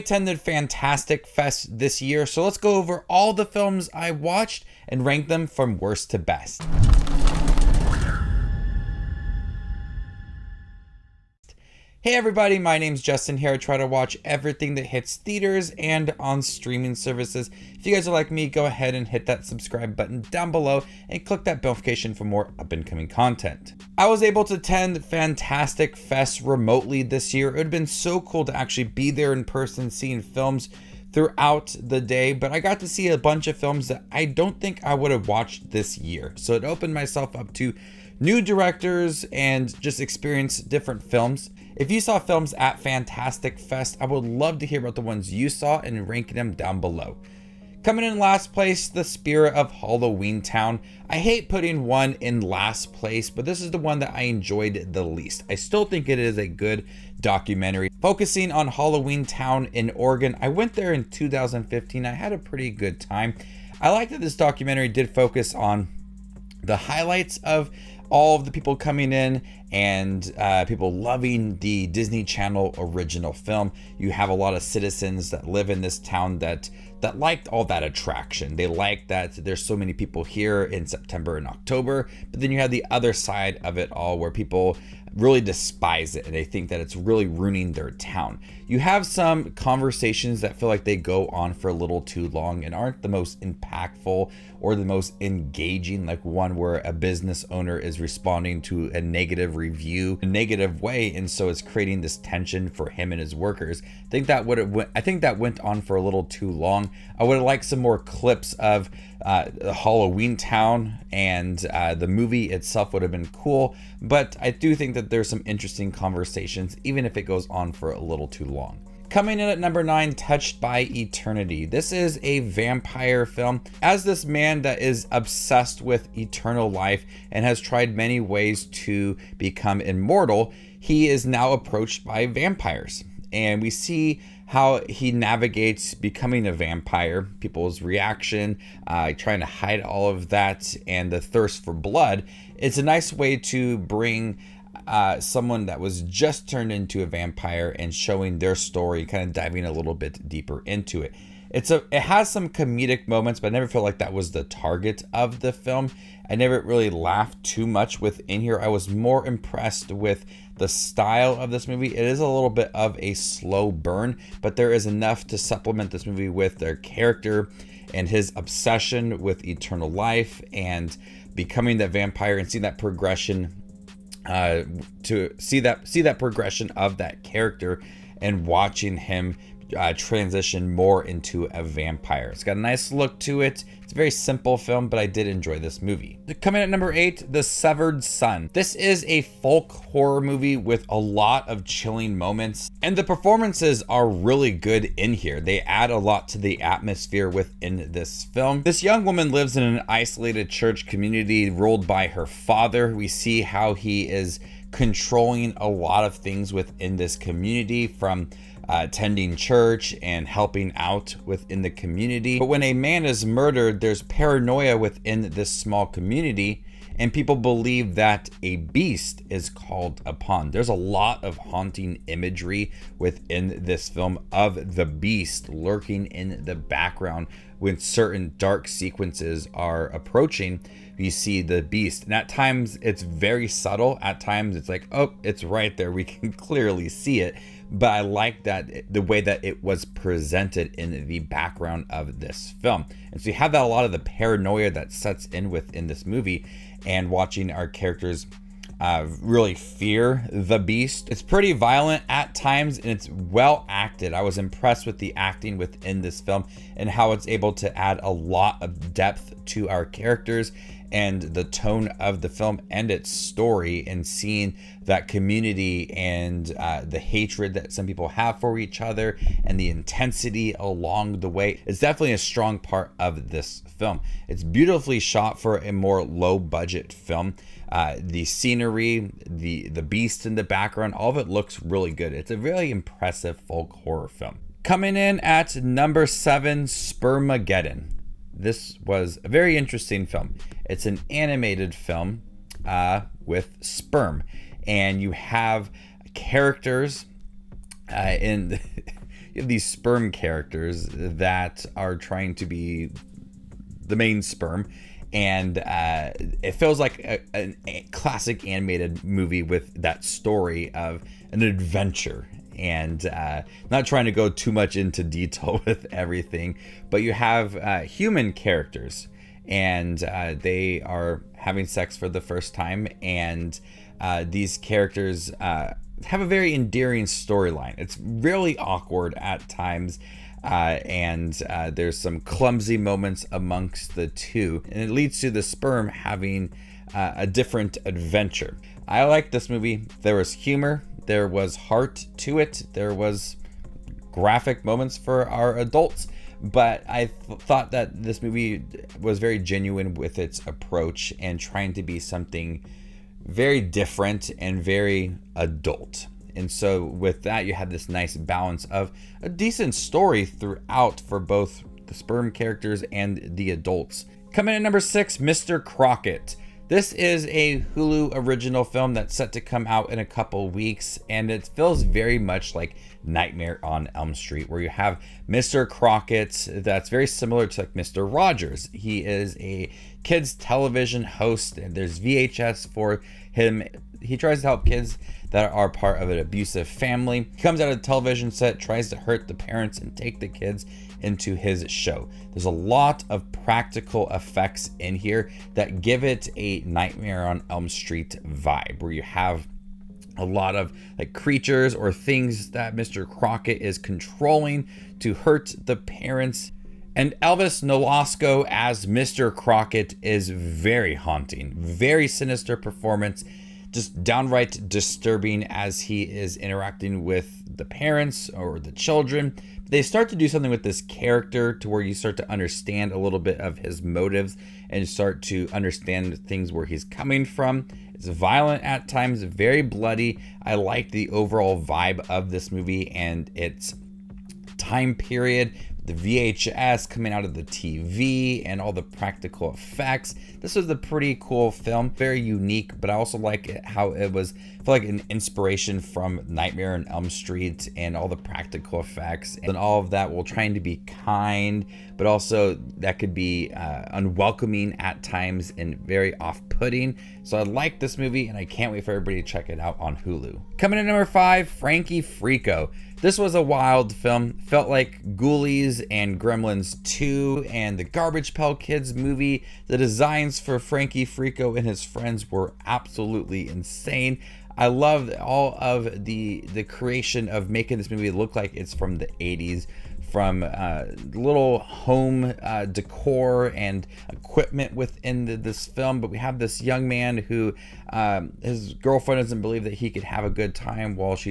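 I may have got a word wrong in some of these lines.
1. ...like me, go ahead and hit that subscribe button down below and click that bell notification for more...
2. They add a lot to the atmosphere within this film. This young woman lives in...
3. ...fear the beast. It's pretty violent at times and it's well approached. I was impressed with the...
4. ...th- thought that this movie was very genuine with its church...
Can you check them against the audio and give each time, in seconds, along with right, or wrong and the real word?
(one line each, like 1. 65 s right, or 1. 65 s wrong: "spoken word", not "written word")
1. 18 s right
2. 195 s right
3. 249 s wrong: "acted", not "approached"
4. 347 s wrong: "approach", not "church".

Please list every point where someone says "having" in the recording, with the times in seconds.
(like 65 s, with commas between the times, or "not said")
321 s, 335 s.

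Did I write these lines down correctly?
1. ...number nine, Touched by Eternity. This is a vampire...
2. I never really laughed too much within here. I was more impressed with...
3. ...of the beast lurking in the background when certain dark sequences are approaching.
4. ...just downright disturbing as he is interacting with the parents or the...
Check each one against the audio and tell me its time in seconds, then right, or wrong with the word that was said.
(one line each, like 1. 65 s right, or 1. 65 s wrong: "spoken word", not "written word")
1. 119 s right
2. 156 s right
3. 224 s right
4. 413 s right.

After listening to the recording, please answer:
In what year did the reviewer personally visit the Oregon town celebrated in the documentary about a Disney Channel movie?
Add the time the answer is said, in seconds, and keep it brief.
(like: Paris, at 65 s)
2015, at 61 s.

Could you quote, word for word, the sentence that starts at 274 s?
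It's beautifully shot for a more low budget film.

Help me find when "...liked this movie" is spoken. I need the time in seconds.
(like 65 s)
339 s.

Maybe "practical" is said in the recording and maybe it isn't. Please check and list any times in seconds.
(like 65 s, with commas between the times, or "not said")
393 s, 438 s, 448 s.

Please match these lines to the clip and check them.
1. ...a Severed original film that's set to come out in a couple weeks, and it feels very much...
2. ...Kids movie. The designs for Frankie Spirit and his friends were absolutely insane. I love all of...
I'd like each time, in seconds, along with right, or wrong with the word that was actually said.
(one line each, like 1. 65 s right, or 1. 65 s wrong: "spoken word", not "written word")
1. 367 s wrong: "Hulu", not "Severed"
2. 468 s wrong: "Freako", not "Spirit".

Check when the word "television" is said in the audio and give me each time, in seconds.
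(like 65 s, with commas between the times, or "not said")
380 s, 387 s.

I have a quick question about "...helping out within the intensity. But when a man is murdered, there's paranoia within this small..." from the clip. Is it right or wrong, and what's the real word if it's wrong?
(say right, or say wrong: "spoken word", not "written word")
wrong: "community", not "intensity".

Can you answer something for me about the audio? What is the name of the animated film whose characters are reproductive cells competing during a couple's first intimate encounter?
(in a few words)
Spermageddon.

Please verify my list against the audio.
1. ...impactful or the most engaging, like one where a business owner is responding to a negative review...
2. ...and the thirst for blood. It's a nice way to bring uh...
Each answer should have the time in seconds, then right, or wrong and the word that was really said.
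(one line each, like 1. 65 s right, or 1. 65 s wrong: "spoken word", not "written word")
1. 93 s right
2. 140 s right.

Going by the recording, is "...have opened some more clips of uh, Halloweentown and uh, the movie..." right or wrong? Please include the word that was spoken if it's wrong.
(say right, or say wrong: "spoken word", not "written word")
wrong: "liked", not "opened".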